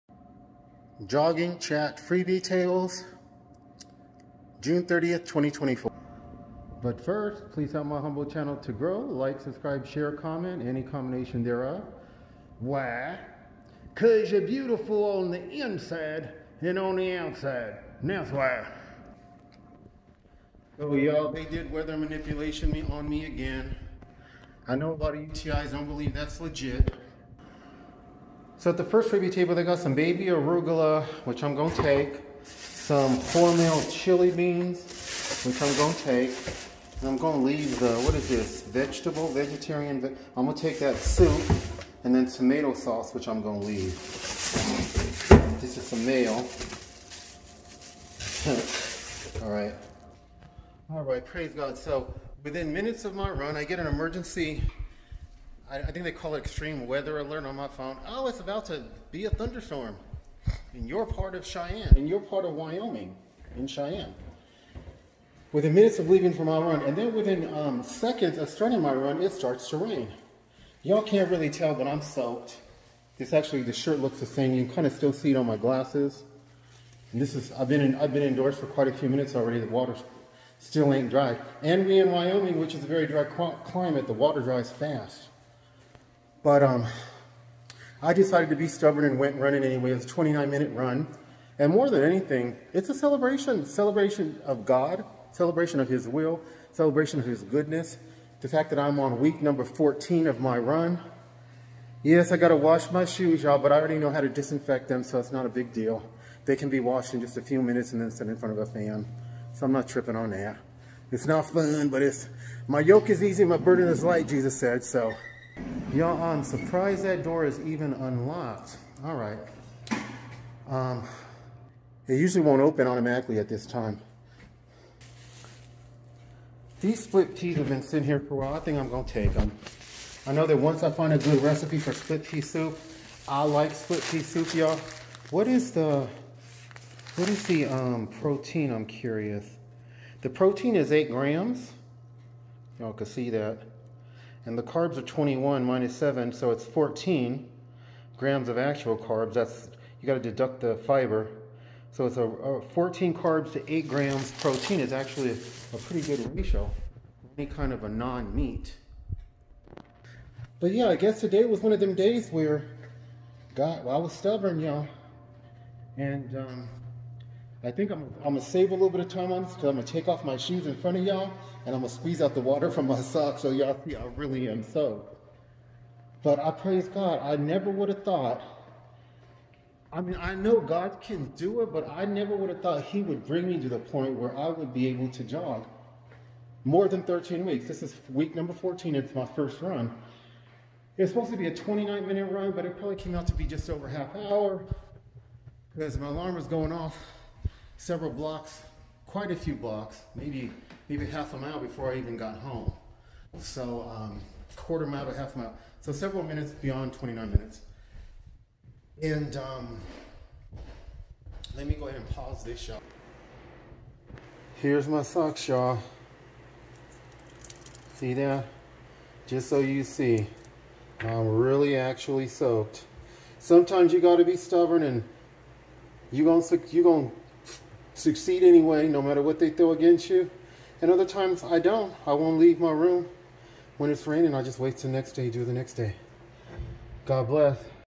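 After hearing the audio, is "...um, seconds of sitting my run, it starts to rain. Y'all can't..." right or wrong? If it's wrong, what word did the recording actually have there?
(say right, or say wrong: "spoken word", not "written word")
wrong: "starting", not "sitting".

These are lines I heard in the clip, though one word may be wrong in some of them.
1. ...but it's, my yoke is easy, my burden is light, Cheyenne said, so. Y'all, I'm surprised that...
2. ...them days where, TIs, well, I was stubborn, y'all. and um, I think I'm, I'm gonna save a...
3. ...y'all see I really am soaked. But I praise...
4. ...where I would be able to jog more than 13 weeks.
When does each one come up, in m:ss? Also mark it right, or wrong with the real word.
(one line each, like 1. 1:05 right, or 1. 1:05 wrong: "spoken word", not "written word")
1. 1:51 wrong: "Jesus", not "Cheyenne"
2. 2:41 wrong: "God", not "TIs"
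3. 2:53 right
4. 3:04 right.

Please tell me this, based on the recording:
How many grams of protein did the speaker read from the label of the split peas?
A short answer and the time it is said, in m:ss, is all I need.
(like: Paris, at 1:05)
8 grams, at 2:20.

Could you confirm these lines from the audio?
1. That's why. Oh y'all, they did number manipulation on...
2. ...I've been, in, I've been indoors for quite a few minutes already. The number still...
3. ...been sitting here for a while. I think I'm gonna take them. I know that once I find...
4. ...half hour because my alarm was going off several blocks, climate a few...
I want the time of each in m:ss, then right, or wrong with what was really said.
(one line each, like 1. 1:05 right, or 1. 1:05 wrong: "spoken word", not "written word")
1. 0:18 wrong: "weather", not "number"
2. 1:17 wrong: "water", not "number"
3. 2:07 right
4. 3:13 wrong: "quite", not "climate".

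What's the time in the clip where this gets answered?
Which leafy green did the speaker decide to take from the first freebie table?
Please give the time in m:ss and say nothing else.
0:29.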